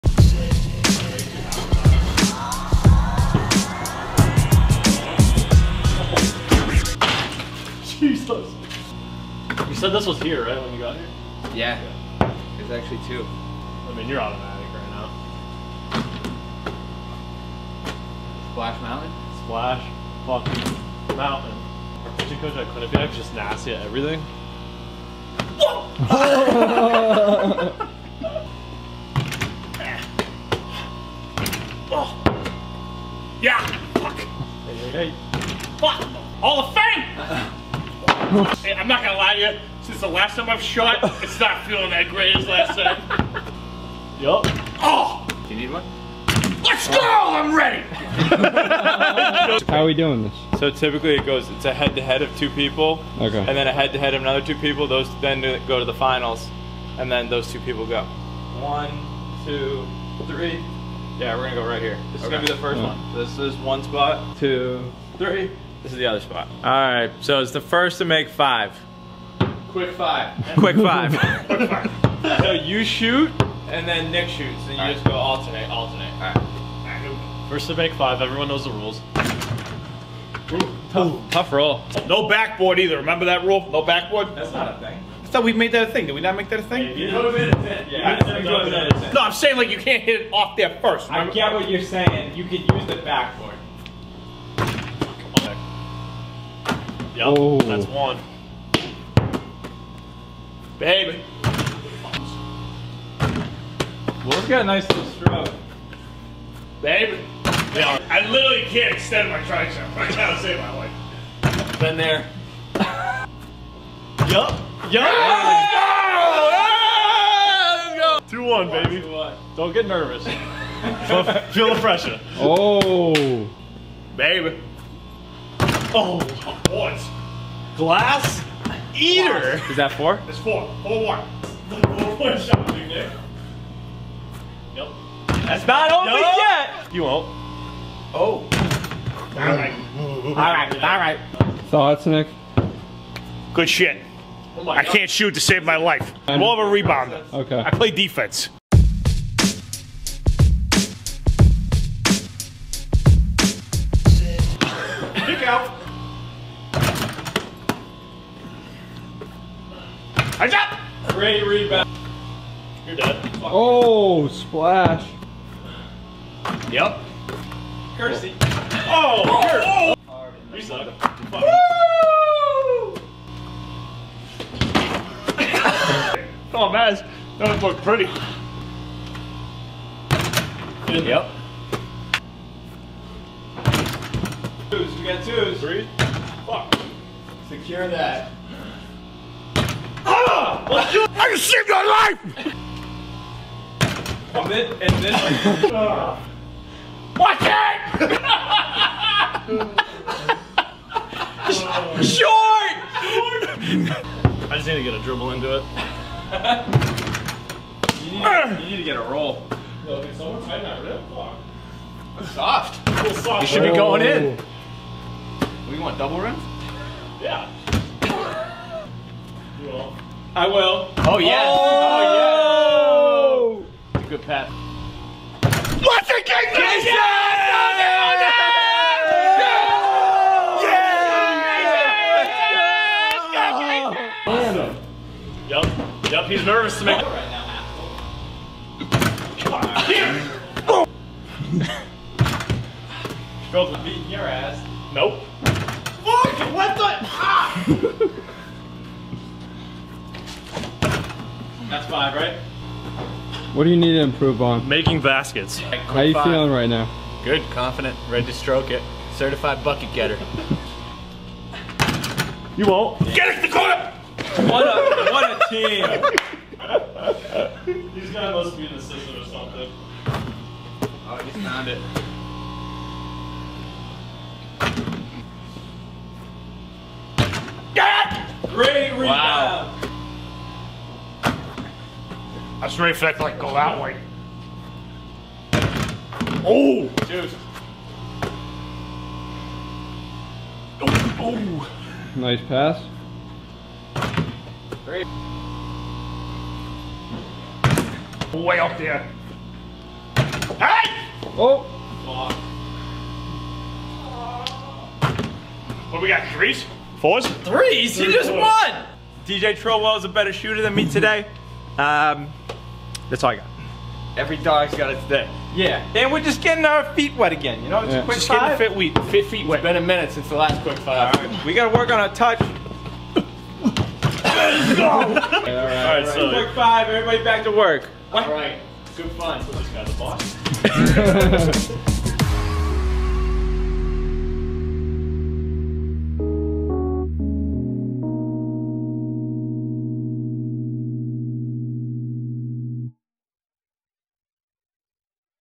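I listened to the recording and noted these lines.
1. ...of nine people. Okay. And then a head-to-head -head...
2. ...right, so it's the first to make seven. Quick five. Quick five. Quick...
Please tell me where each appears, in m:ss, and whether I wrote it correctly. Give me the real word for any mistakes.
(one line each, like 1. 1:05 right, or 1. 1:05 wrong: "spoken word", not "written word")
1. 0:52 wrong: "two", not "nine"
2. 1:06 wrong: "five", not "seven".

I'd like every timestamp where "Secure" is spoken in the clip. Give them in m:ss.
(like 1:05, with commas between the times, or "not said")
3:07.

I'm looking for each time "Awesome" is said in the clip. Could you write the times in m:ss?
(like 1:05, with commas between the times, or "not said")
3:54.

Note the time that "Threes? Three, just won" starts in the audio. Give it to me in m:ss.
5:07.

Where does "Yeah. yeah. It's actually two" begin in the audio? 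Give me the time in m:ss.
0:11.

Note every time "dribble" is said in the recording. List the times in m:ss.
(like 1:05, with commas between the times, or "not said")
3:25.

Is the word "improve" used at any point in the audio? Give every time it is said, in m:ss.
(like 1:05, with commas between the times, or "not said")
4:14.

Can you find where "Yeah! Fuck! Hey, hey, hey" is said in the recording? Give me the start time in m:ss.
0:33.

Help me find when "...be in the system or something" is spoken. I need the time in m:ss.
4:28.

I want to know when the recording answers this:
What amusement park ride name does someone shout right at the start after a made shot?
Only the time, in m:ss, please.
0:18.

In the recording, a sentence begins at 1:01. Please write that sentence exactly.
Yeah, we're gonna go right here.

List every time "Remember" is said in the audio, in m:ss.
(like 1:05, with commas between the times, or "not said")
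1:22, 1:31.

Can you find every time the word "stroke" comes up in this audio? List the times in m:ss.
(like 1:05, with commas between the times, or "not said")
1:45, 4:18.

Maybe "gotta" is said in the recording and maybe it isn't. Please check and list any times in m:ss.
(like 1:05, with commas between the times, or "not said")
1:50, 5:21.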